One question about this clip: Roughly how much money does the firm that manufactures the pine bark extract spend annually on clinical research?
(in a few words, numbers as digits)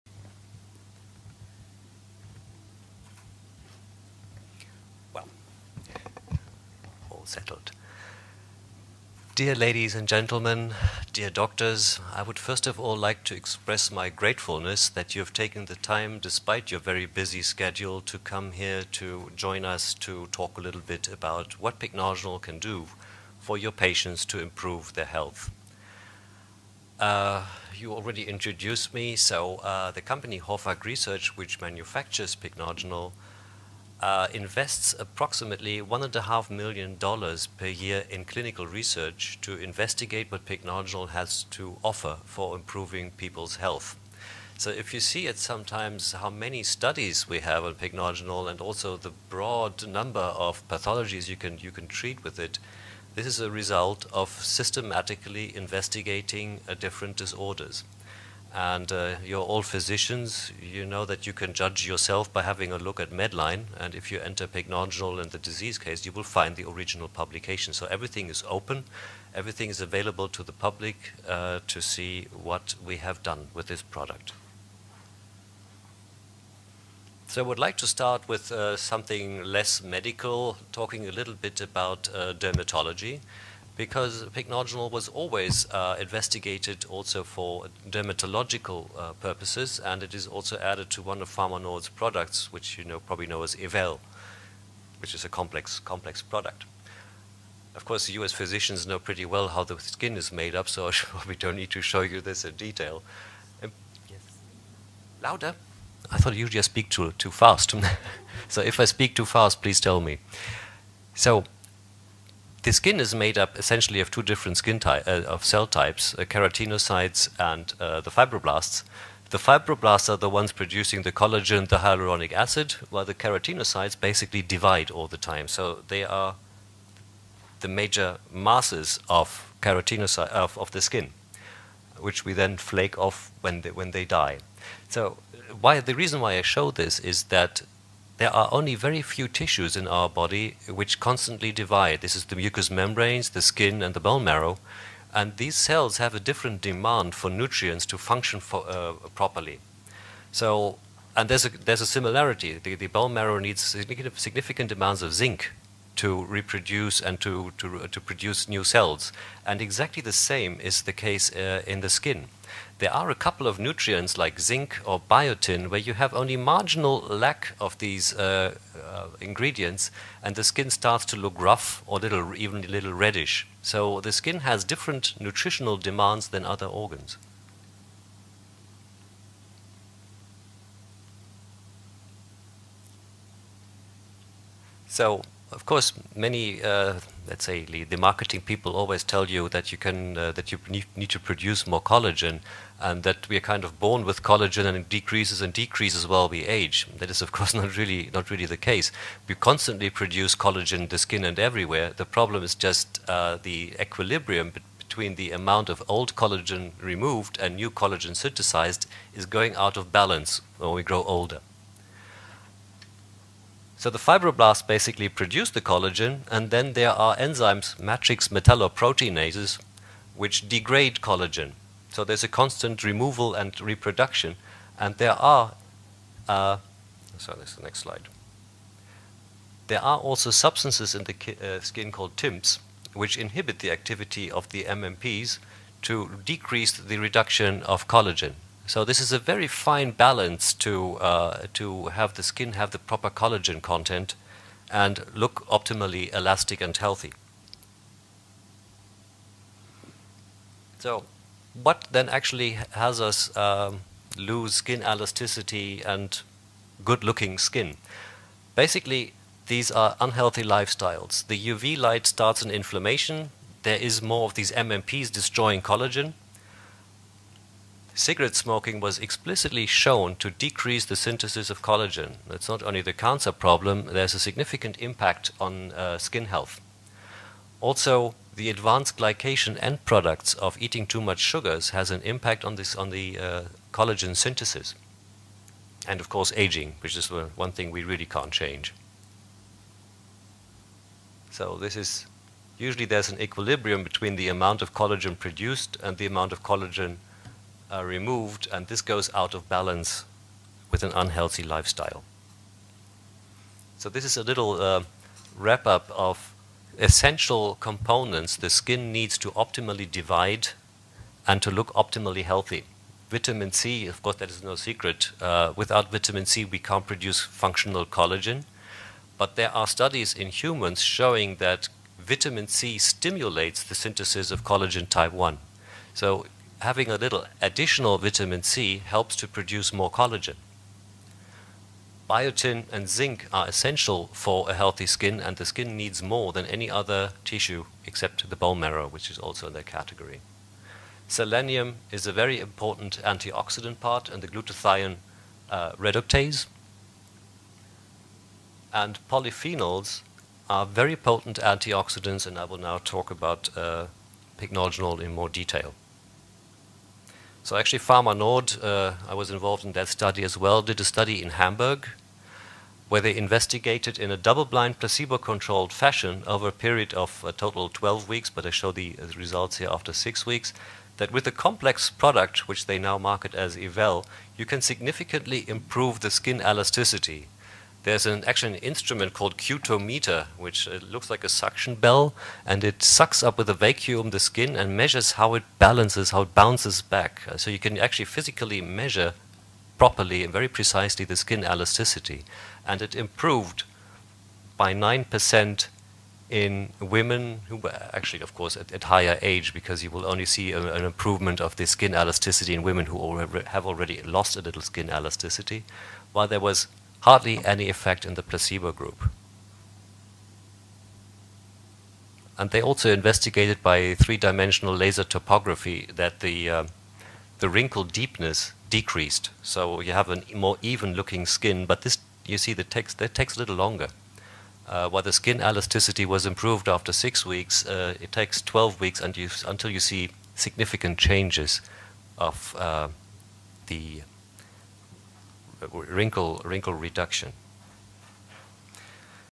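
$1.5 million.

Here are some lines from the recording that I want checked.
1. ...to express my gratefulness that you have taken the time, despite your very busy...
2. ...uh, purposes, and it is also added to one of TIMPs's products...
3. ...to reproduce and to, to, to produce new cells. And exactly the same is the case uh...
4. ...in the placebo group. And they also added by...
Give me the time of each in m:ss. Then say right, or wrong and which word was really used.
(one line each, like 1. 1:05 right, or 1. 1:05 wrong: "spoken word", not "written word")
1. 0:13 right
2. 1:28 wrong: "Pharmanord", not "TIMPs"
3. 2:36 right
4. 6:48 wrong: "investigated", not "added".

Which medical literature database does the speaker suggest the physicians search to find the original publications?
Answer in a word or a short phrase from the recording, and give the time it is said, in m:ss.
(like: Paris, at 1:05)
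Medline, at 1:03.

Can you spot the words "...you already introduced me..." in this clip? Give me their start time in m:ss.
0:27.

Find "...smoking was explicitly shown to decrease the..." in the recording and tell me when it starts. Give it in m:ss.
4:28.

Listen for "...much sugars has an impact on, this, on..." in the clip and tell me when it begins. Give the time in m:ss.
4:41.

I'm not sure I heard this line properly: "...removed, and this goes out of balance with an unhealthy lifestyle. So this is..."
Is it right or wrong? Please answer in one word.
right.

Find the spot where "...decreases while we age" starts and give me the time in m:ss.
3:15.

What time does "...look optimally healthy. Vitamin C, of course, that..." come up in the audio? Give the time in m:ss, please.
5:11.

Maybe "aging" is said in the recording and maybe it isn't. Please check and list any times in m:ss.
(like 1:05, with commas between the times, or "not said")
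4:46.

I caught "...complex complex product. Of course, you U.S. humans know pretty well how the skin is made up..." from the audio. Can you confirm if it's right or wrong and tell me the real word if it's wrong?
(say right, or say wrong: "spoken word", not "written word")
wrong: "physicians", not "humans".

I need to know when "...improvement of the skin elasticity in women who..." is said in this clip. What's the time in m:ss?
6:40.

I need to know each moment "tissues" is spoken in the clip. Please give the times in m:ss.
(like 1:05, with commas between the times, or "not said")
2:19, 5:37.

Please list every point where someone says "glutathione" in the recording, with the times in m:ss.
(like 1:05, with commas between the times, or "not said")
5:44.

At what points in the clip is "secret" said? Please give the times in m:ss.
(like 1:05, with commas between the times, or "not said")
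5:14.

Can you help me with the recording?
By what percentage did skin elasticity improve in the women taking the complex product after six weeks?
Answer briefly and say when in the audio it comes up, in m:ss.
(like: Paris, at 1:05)
9%, at 6:34.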